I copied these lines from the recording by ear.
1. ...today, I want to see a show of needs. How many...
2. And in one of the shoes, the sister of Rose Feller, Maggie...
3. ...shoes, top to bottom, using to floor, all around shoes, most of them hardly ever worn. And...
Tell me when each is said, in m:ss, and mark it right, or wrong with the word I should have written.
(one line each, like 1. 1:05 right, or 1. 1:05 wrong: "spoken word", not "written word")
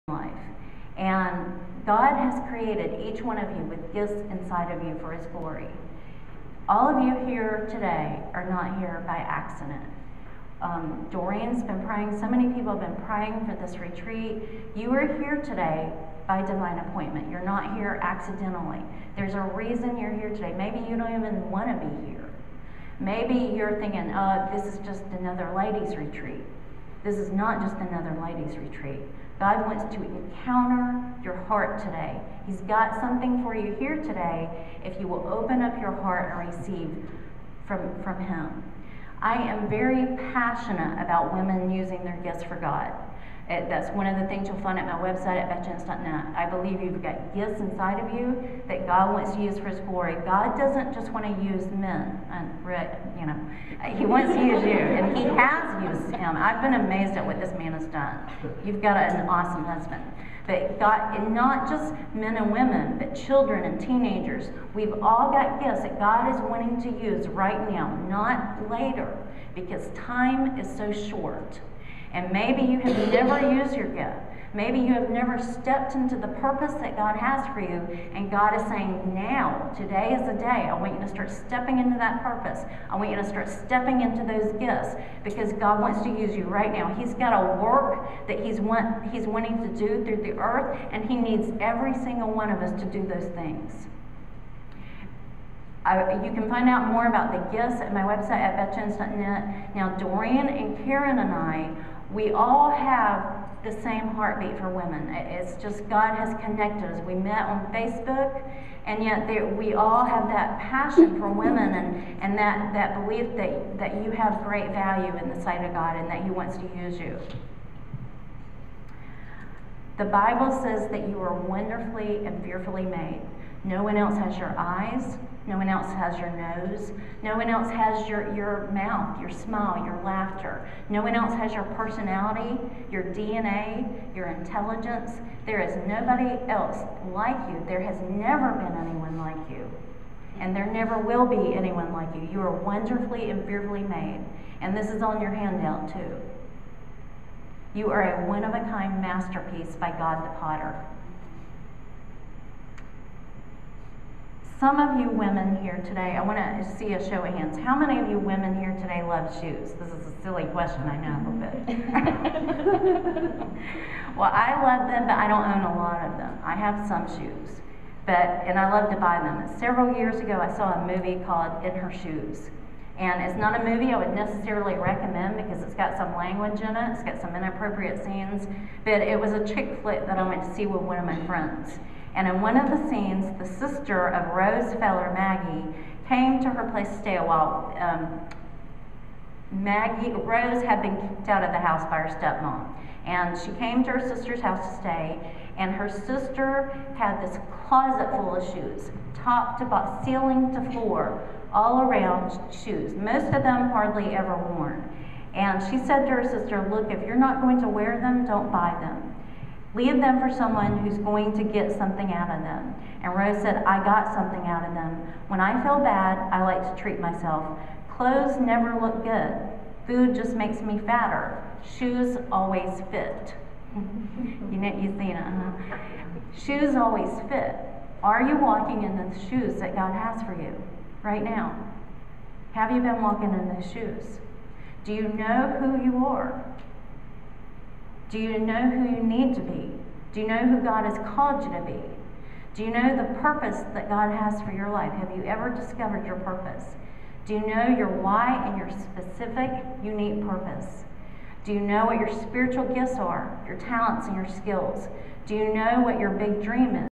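1. 2:35 wrong: "hands", not "needs"
2. 3:02 wrong: "scenes", not "shoes"
3. 3:18 wrong: "ceiling", not "using".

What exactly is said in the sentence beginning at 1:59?
The Bible says that you are wonderfully and fearfully made.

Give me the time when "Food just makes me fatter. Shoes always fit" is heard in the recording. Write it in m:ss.
3:39.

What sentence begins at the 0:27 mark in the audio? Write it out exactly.
This is not just another ladies' retreat.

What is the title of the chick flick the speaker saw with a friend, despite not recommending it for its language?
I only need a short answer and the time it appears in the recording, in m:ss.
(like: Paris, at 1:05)
In Her Shoes, at 2:51.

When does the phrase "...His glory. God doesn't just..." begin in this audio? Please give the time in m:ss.
0:49.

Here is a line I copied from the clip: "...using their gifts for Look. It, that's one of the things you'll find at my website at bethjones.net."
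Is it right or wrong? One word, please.
wrong.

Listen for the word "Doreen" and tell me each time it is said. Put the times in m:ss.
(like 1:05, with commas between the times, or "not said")
0:11, 1:39.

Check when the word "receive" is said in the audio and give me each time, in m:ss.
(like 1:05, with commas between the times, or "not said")
0:36.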